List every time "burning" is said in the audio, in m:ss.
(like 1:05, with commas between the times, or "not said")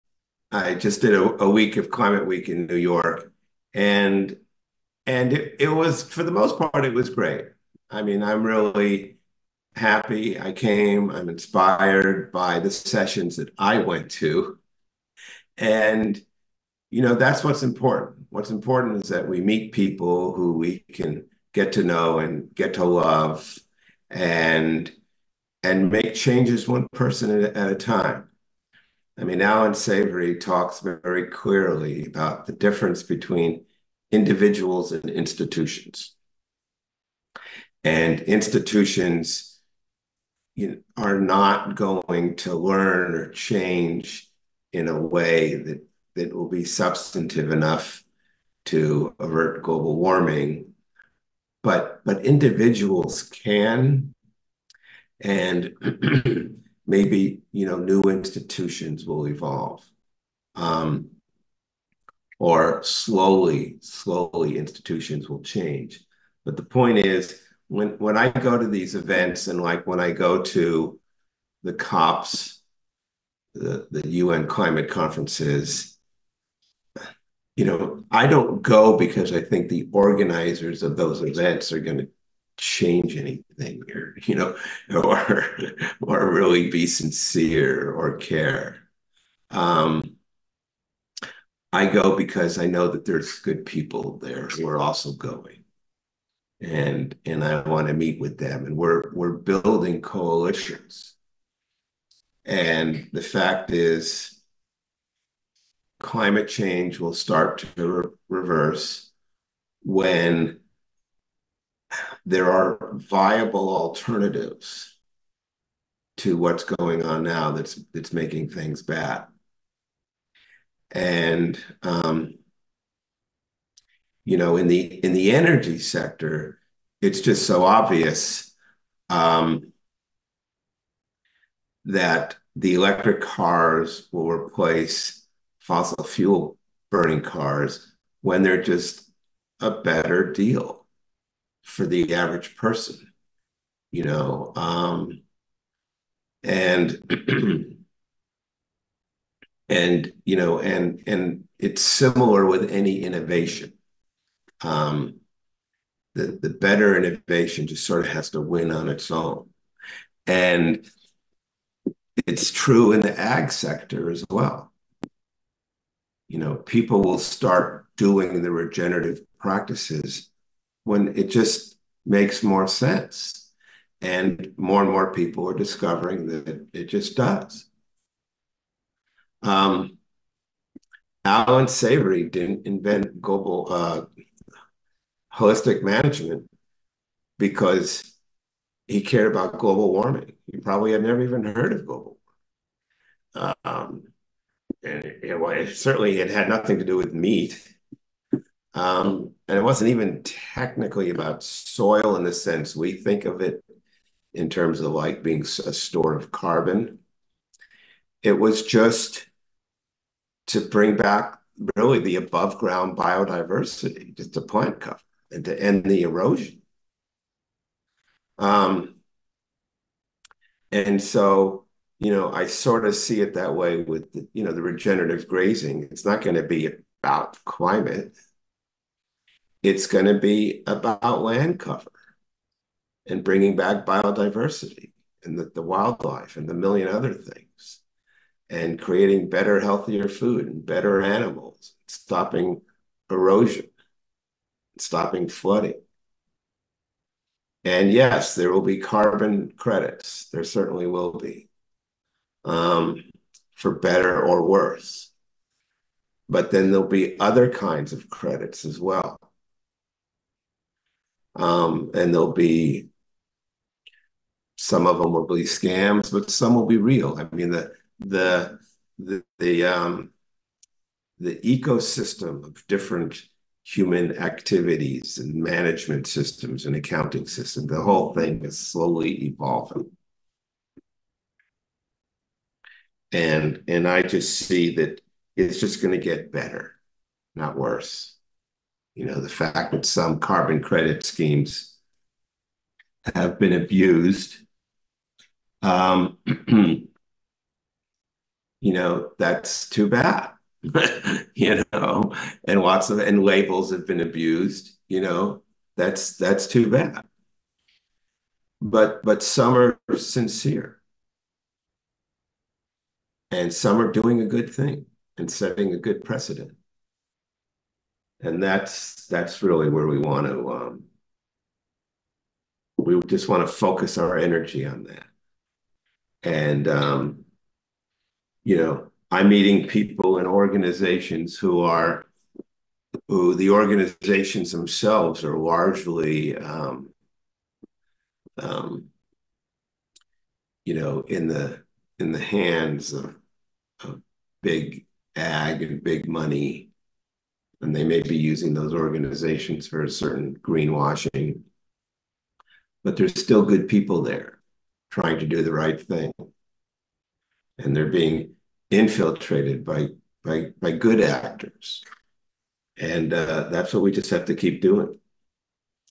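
2:16.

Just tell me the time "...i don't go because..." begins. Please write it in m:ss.
1:18.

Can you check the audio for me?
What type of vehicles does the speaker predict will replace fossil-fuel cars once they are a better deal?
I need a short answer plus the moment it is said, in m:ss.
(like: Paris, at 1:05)
electric cars, at 2:12.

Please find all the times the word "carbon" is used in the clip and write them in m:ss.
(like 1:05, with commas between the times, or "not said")
3:26, 4:08, 4:50.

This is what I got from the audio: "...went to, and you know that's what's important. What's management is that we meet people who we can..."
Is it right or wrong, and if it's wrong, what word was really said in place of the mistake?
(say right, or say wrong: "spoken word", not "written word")
wrong: "important", not "management".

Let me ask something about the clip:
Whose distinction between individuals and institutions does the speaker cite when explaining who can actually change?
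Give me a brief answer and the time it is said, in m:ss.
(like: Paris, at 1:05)
Alan Savory, at 0:29.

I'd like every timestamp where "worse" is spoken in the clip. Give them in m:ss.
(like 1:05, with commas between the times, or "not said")
4:14, 4:47.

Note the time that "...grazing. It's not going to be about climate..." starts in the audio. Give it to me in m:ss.
3:45.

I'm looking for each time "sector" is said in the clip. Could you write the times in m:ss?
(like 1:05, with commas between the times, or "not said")
2:05, 2:43.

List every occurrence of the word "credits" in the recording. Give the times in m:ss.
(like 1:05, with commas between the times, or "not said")
4:09, 4:18, 4:50.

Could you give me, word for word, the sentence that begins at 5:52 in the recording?
But there's still good people there trying to do the right thing.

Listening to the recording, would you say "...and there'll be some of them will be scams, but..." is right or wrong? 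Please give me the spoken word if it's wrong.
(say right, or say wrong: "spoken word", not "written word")
right.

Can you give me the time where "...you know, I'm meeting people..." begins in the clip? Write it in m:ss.
5:28.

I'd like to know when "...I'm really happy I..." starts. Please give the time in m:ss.
0:08.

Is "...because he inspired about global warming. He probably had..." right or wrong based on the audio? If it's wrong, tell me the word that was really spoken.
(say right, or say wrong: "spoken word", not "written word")
wrong: "cared", not "inspired".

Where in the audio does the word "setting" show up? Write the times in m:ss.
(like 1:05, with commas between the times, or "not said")
5:15.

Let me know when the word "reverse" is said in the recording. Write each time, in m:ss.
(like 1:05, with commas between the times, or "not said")
1:48.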